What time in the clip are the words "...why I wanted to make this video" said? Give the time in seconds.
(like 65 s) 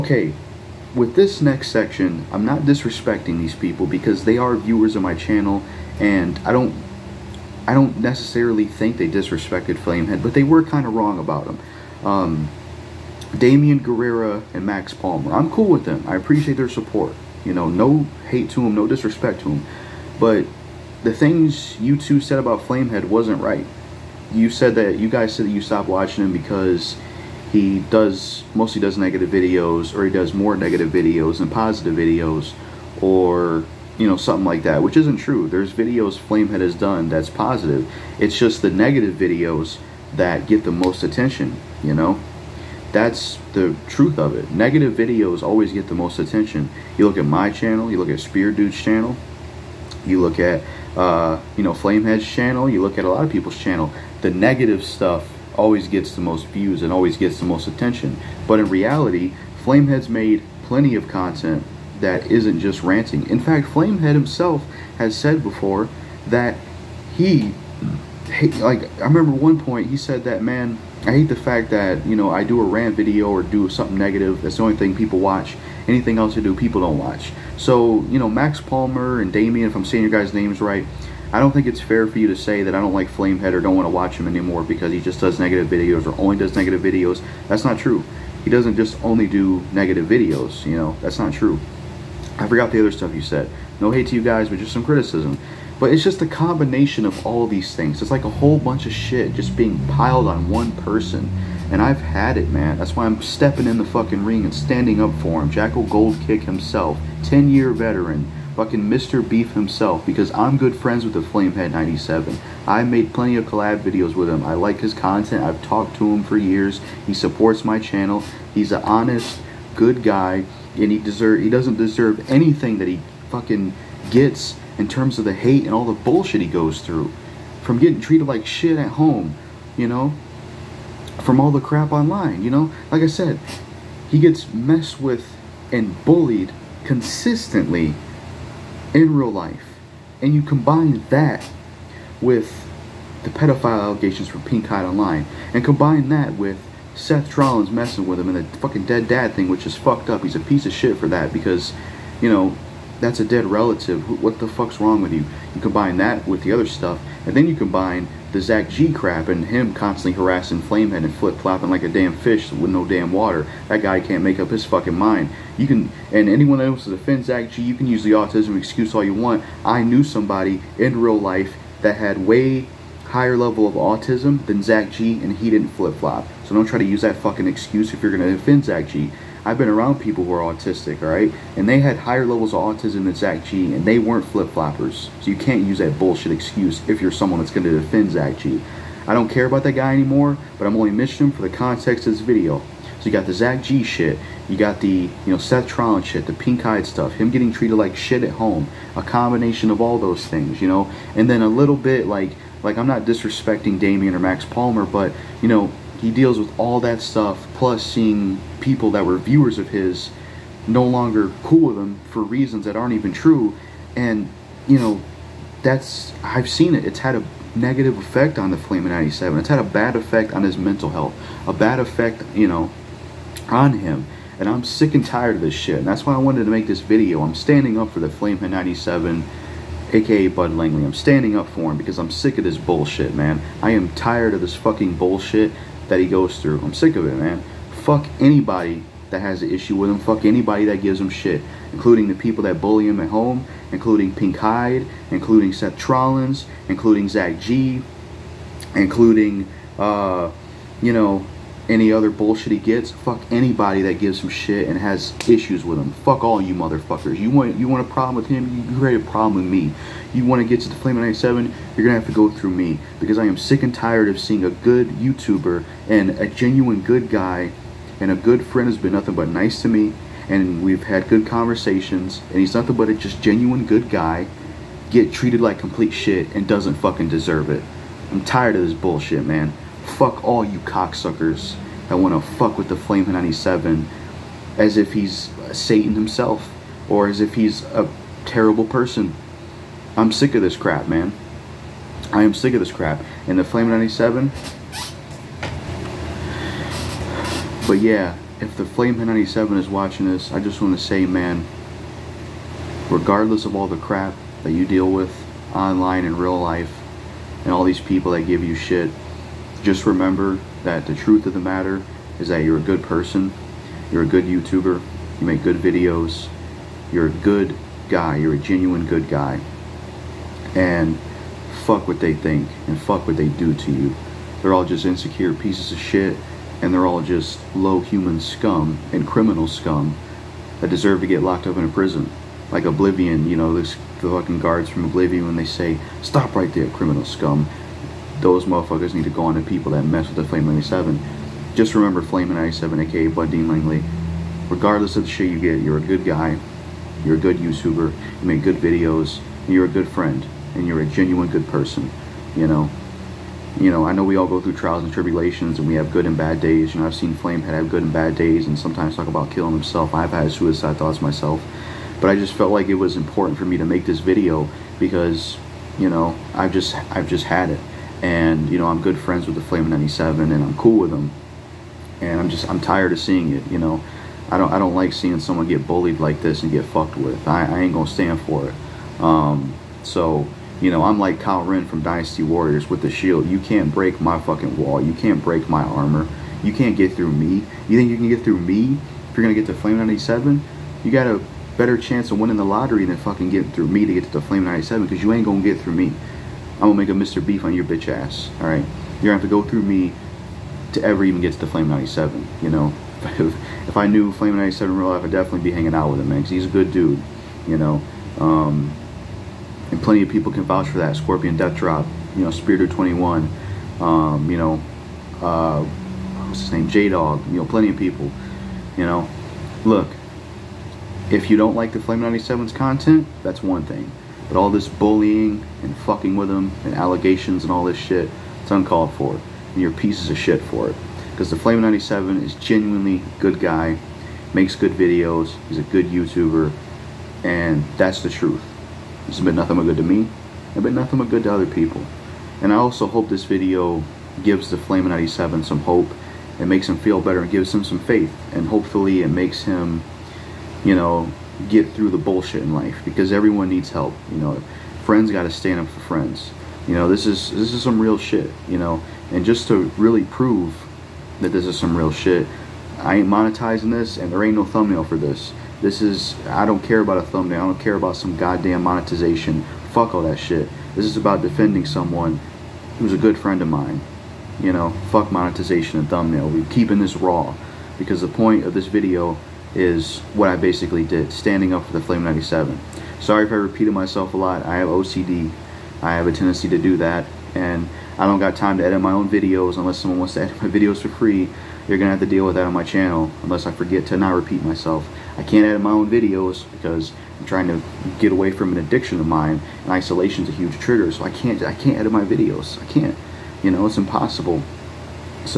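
226 s.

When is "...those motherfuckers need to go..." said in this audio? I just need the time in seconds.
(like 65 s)
338 s.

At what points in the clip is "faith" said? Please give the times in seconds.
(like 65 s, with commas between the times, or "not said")
447 s.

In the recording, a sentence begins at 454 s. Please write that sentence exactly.
You know, friends got to stand up for friends.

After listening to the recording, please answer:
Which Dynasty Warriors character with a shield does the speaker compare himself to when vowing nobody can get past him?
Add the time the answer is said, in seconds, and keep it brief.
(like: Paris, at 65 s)
Cao Ren, at 381 s.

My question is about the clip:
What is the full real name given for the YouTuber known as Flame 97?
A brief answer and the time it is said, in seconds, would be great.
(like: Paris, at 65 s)
Bud Dean Langley, at 343 s.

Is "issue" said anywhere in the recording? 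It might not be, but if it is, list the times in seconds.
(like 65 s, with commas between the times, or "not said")
239 s, 255 s.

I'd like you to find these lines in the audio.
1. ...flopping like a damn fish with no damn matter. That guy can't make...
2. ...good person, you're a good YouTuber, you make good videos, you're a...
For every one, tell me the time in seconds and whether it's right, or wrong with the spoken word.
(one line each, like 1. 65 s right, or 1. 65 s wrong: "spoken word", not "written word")
1. 161 s wrong: "water", not "matter"
2. 312 s right.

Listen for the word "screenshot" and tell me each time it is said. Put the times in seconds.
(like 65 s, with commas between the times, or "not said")
not said.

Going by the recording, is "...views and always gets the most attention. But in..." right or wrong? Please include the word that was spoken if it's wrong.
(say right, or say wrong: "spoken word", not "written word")
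right.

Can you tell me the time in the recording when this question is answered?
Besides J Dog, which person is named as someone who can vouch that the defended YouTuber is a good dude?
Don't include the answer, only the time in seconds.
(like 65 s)
410 s.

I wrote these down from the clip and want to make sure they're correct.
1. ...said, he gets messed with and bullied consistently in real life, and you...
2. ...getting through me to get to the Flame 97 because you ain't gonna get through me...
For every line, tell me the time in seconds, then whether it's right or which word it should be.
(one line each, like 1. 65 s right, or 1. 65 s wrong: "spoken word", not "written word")
1. 133 s right
2. 393 s right.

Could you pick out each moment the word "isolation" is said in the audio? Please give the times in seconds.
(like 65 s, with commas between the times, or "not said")
499 s.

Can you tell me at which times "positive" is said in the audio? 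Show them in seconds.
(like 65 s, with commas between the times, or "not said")
31 s, 37 s.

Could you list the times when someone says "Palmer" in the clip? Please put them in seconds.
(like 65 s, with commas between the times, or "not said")
14 s, 78 s, 204 s.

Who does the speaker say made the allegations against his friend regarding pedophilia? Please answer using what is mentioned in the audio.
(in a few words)
Pink Hyde Online.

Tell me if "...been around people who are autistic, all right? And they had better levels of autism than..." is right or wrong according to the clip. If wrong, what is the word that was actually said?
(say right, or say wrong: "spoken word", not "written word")
wrong: "higher", not "better".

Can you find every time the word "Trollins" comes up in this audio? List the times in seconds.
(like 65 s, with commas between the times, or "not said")
147 s, 195 s, 245 s.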